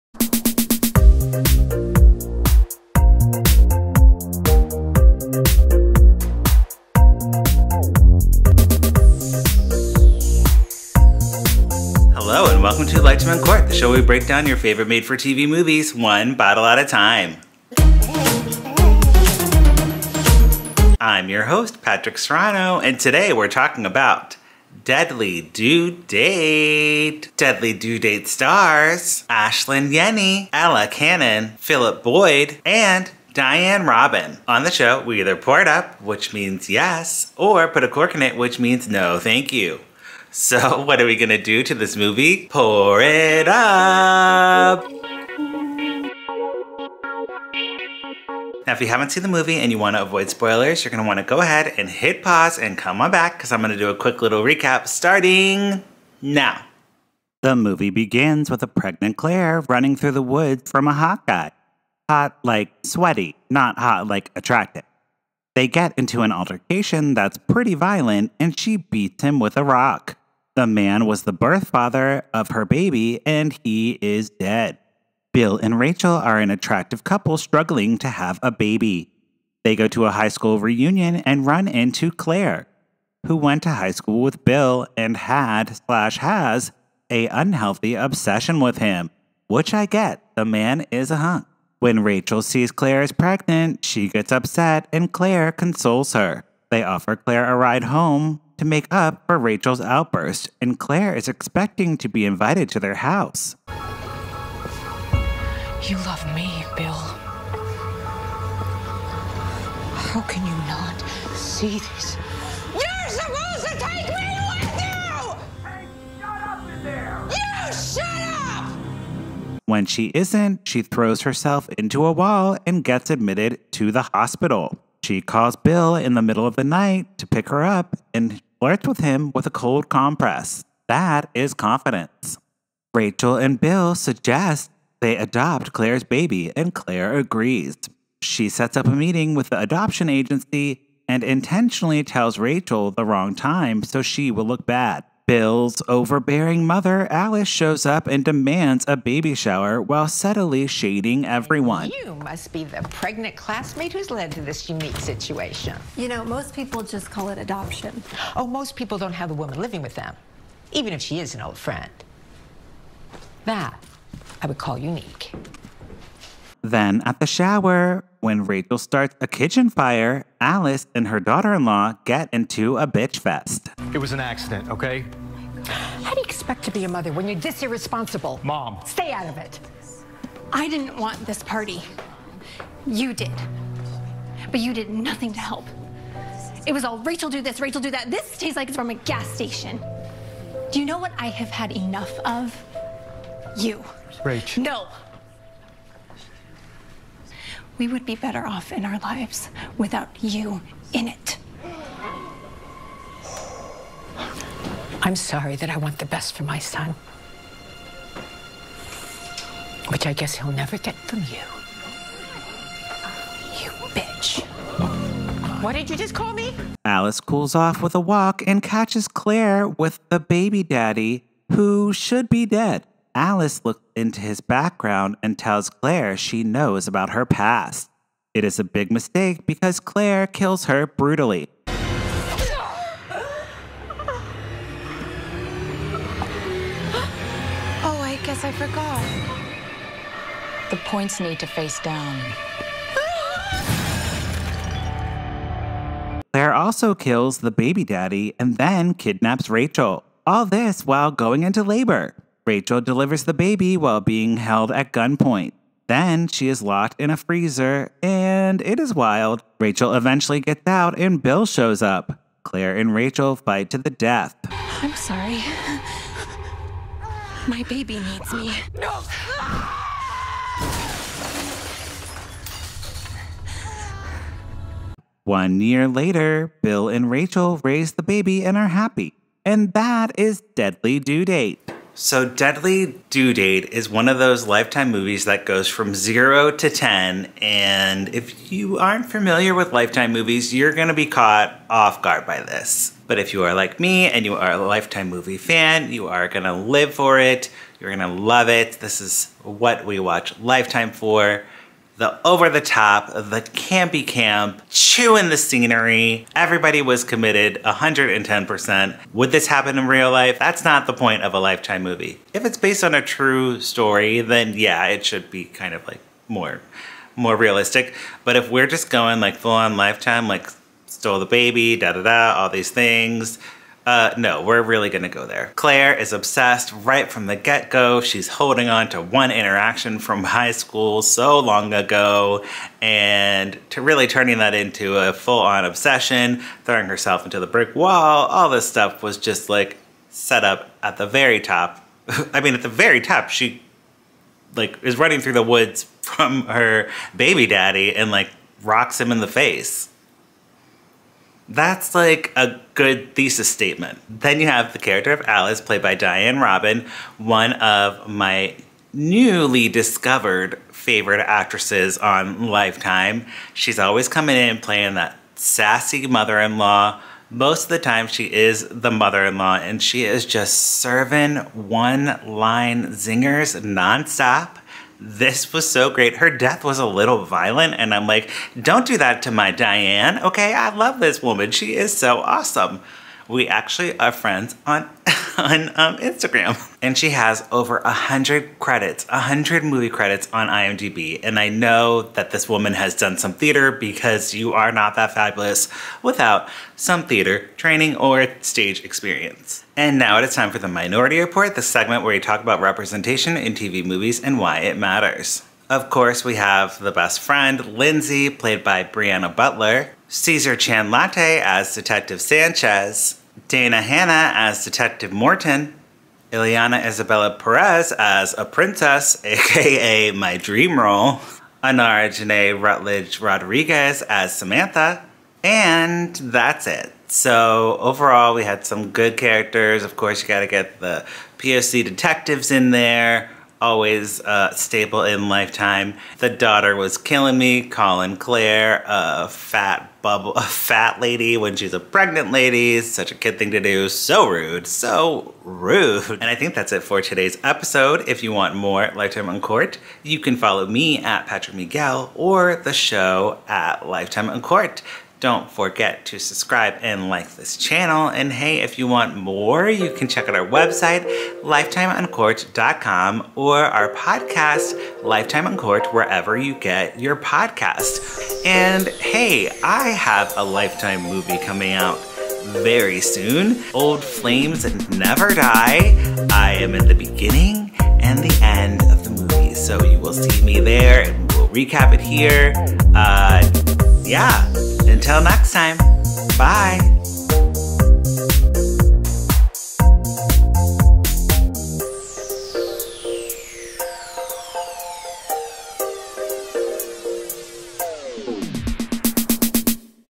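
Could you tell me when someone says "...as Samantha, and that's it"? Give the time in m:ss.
7:04.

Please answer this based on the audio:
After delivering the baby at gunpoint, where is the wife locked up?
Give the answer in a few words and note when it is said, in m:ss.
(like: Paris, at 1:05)
A freezer, at 4:17.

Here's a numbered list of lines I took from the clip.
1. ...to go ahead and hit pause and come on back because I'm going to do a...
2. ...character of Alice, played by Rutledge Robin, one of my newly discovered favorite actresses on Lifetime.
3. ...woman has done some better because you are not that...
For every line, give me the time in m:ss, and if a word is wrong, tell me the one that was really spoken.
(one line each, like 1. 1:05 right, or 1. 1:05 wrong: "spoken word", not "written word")
1. 0:51 right
2. 5:54 wrong: "Diane", not "Rutledge"
3. 6:32 wrong: "theater", not "better".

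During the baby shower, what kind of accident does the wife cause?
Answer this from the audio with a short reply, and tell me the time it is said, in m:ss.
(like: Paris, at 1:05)
A kitchen fire, at 2:49.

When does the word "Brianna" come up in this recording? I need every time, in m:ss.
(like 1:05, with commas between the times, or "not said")
6:48.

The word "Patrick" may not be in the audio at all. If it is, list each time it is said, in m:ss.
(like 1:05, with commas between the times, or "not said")
0:21, 7:31.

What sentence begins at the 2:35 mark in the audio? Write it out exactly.
You know, most people just call it adoption.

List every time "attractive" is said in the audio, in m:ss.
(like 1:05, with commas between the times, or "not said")
1:04, 1:16.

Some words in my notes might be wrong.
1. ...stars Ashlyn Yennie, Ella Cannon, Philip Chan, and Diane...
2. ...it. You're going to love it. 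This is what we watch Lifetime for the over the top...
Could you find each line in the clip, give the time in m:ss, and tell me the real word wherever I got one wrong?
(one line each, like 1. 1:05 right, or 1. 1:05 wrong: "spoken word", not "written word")
1. 0:28 wrong: "Boyd", not "Chan"
2. 4:57 right.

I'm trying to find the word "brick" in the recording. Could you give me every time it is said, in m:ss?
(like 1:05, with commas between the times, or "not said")
5:37.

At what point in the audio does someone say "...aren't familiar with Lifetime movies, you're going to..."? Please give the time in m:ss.
4:48.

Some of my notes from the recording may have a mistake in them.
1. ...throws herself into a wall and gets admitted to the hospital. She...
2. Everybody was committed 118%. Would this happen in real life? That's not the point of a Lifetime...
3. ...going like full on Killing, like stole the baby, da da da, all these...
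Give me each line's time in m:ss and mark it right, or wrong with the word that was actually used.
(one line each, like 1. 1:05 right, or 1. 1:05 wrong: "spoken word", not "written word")
1. 2:00 right
2. 5:06 wrong: "110", not "118"
3. 5:18 wrong: "Lifetime", not "Killing".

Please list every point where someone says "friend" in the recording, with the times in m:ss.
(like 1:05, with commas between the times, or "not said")
2:41, 6:24, 6:47.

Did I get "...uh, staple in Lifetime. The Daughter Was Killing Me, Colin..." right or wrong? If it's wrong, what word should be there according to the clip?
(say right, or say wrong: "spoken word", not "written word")
right.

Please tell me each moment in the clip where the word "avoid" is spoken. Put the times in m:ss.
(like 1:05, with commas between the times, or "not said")
0:50.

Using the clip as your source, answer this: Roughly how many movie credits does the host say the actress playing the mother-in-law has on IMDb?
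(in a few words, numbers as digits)
Over 100.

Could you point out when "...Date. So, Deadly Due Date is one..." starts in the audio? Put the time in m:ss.
4:41.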